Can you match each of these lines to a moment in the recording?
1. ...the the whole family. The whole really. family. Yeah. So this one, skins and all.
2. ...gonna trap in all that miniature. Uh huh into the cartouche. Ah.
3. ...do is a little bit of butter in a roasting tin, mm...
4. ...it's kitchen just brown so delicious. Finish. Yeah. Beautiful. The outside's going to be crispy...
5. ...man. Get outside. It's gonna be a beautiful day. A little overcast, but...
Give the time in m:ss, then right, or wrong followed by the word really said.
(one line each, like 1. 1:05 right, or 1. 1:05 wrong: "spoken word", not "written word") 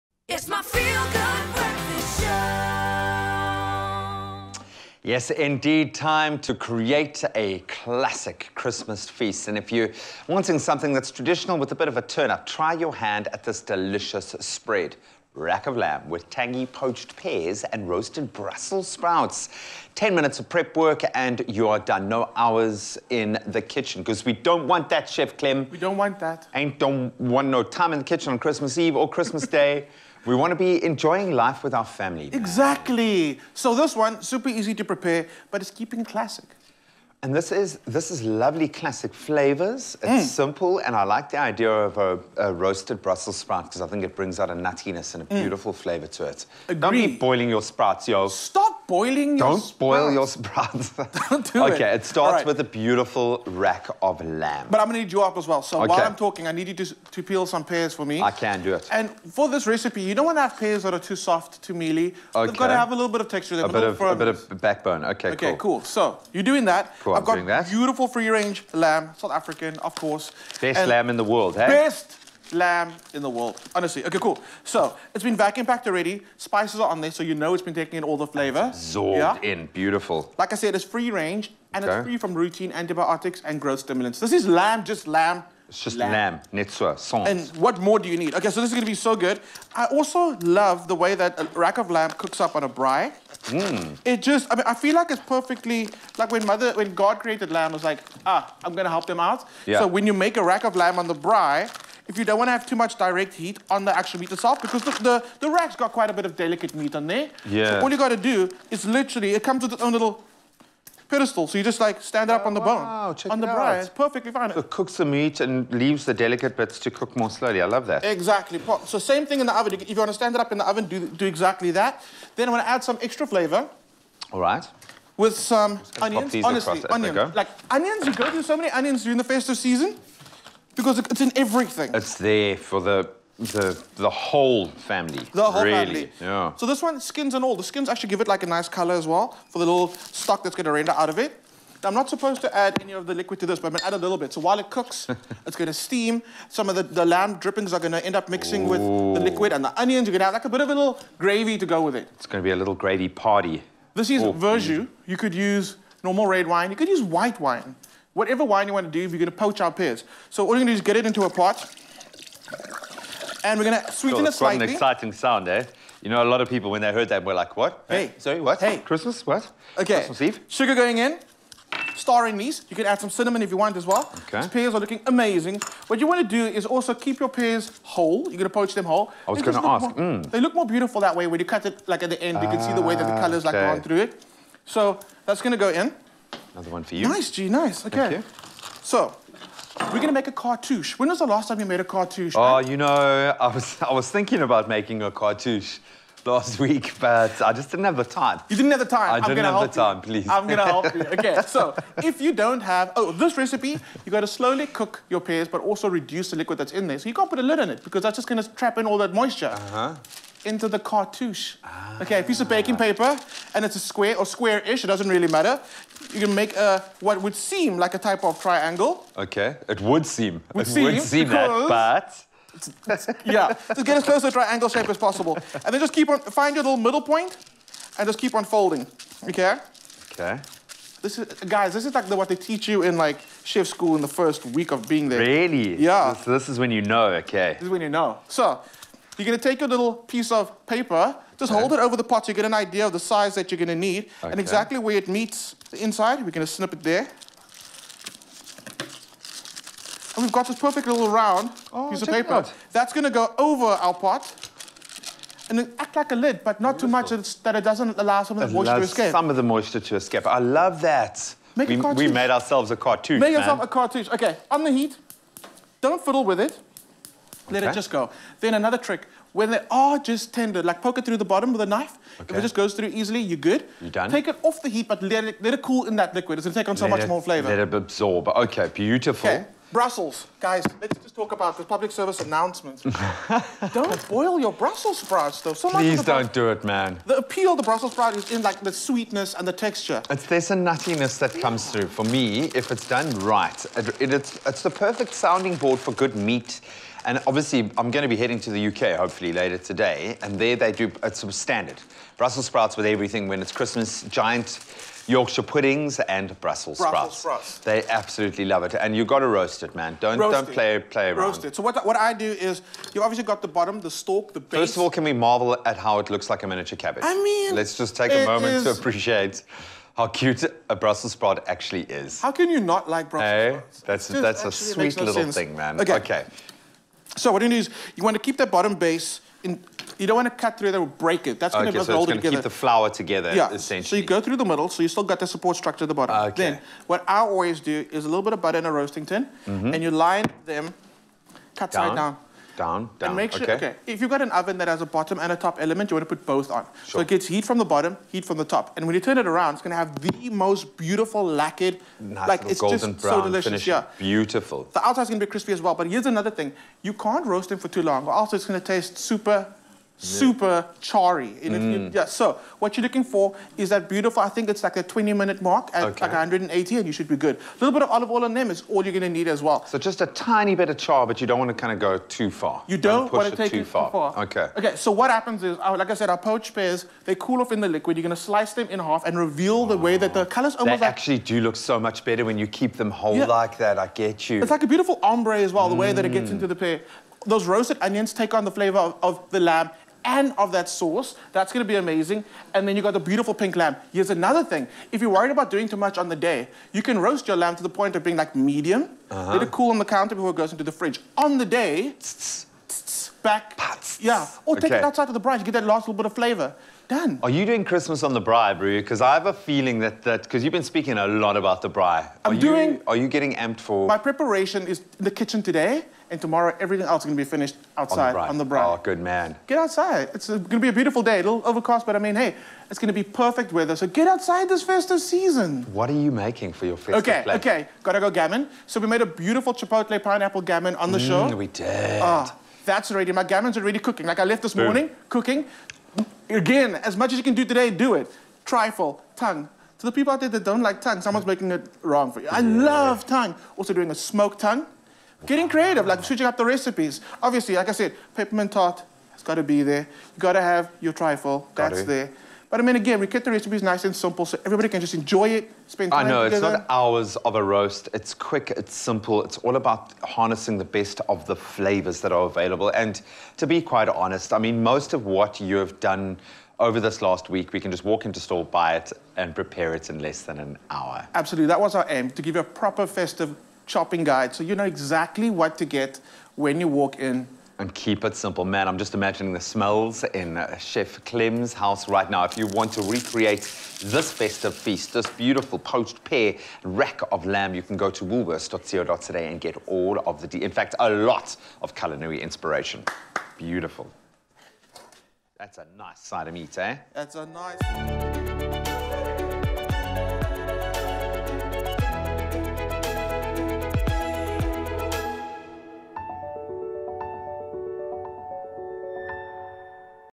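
1. 2:13 right
2. 3:28 wrong: "moisture", not "miniature"
3. 5:37 right
4. 5:52 wrong: "golden", not "kitchen"
5. 6:59 right.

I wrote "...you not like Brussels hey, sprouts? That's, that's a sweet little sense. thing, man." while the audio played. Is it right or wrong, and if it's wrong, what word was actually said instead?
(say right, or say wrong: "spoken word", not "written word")
right.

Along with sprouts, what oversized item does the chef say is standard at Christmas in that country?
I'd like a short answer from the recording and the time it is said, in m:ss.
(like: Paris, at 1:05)
Yorkshire puddings, at 5:05.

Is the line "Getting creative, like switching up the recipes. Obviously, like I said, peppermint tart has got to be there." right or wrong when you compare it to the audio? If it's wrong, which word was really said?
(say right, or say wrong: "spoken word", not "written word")
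right.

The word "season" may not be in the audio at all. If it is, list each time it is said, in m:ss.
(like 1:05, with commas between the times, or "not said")
2:09, 7:05.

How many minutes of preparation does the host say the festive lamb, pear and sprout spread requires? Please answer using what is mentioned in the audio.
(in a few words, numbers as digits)
10.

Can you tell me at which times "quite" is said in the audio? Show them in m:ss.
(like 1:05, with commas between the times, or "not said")
1:45, 2:44, 7:43.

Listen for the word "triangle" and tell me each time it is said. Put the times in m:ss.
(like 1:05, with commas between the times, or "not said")
3:38, 3:44.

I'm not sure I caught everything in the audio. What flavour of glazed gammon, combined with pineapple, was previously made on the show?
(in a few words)
Chipotle.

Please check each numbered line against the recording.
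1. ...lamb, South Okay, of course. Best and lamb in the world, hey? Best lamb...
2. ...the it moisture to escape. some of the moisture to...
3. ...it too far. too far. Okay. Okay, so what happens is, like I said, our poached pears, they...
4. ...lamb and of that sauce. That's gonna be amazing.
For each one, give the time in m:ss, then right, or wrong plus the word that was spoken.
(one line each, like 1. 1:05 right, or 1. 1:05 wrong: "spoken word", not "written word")
1. 1:08 wrong: "African", not "Okay"
2. 4:18 right
3. 6:13 right
4. 6:29 right.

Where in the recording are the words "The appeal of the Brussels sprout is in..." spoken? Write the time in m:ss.
4:47.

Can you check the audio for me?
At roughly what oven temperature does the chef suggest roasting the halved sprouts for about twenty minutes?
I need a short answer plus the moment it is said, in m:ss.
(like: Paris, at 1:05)
180, at 6:06.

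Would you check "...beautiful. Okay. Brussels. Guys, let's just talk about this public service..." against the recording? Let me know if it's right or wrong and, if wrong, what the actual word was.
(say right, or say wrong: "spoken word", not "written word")
right.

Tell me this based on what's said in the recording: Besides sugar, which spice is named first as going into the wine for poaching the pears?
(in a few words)
Star anise.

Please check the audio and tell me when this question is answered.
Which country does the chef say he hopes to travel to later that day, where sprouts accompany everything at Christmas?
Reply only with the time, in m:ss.
4:58.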